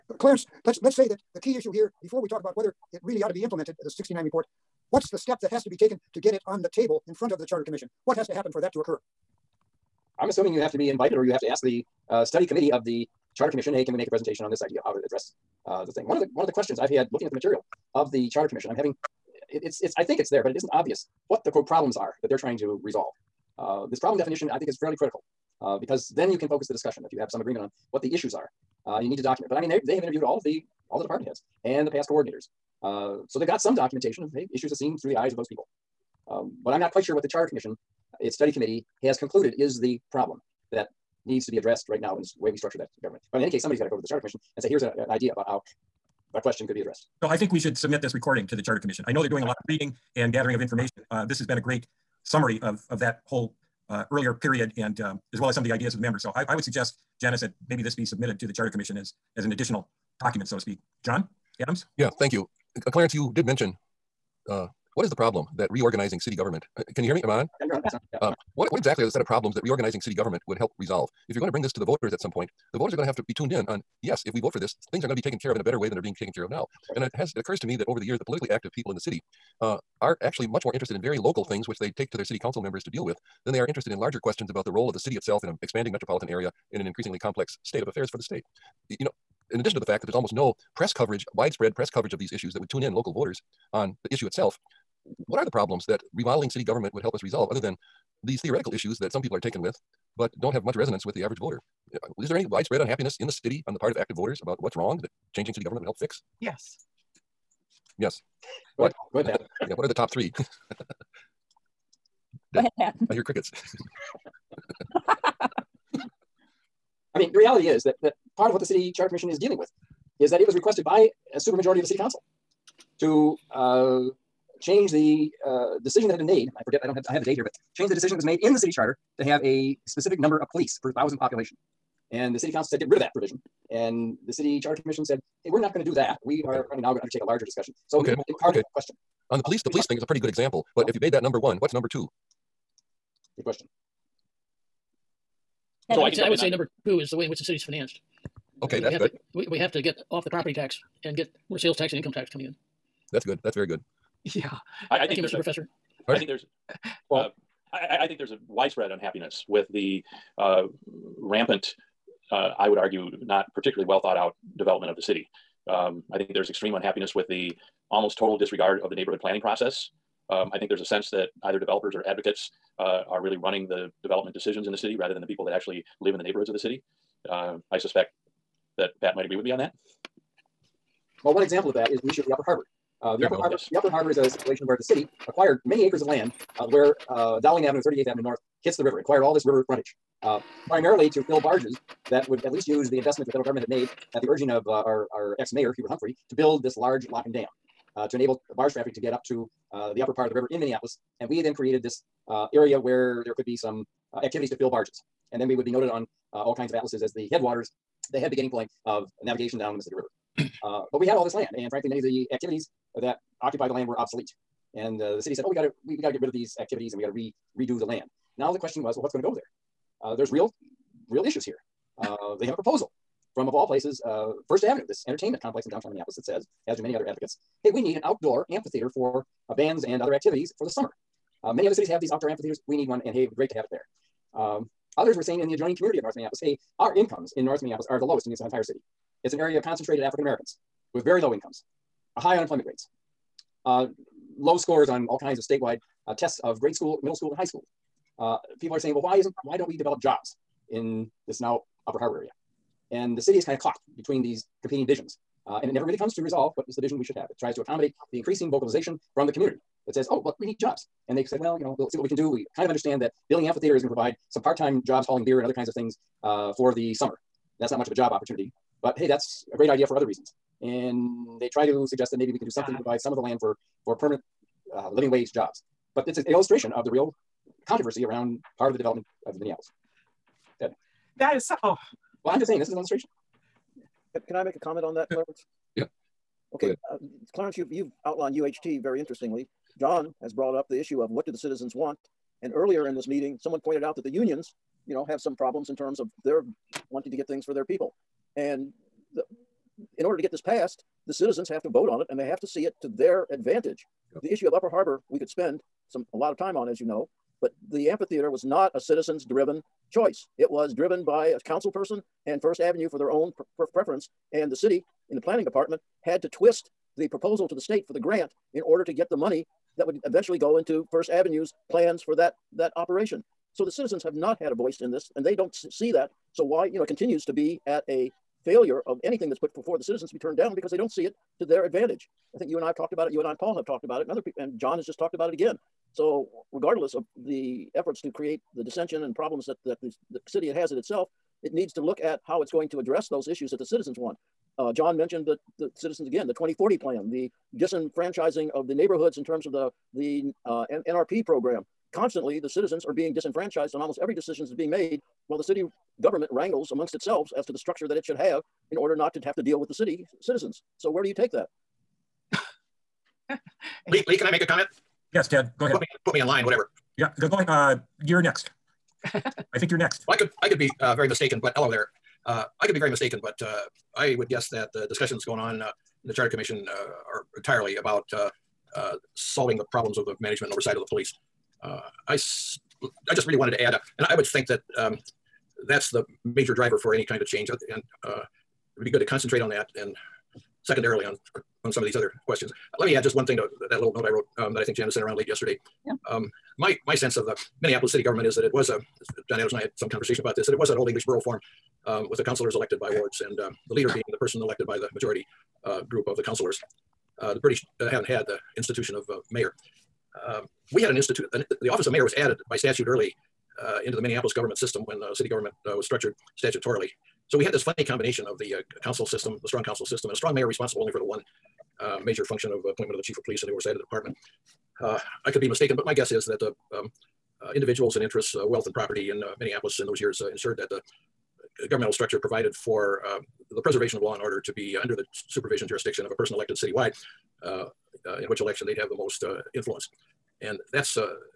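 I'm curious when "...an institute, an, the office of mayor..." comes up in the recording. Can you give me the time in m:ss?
6:50.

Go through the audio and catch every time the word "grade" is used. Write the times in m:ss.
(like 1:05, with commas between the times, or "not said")
4:06.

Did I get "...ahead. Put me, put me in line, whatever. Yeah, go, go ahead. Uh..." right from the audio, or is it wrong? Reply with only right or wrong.
right.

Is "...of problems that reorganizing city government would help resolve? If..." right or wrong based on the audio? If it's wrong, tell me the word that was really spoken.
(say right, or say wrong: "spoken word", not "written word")
right.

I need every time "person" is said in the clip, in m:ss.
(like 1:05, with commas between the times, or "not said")
5:11, 6:44, 7:16.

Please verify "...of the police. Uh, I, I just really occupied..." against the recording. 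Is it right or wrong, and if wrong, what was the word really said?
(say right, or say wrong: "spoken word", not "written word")
wrong: "wanted", not "occupied".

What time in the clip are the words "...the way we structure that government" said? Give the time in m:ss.
0:42.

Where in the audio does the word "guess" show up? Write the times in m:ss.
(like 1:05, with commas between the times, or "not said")
6:14, 7:05.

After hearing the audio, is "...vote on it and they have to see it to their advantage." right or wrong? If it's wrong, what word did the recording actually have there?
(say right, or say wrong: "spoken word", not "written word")
right.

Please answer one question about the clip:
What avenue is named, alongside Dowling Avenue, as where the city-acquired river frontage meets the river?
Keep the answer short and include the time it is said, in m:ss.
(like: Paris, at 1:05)
38th Avenue North, at 3:07.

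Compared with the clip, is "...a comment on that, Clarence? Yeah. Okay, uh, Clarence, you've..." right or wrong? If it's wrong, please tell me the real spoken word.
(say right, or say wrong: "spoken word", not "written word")
right.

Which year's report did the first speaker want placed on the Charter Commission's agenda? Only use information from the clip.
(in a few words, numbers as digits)
69 report.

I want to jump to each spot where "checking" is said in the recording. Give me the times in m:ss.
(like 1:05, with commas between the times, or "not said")
not said.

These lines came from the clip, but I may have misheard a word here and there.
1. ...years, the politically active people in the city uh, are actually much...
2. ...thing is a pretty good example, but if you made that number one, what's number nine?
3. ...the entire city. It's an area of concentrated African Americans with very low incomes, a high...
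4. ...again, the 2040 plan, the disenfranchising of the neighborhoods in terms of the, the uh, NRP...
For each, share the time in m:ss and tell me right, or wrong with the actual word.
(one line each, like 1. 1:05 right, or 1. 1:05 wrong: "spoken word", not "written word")
1. 1:18 right
2. 2:19 wrong: "two", not "nine"
3. 3:58 right
4. 5:46 right.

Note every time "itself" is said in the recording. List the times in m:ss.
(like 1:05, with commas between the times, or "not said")
1:25, 1:34, 5:40, 5:56.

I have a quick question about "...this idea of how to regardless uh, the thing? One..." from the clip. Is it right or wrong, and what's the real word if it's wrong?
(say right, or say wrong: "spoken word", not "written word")
wrong: "address", not "regardless".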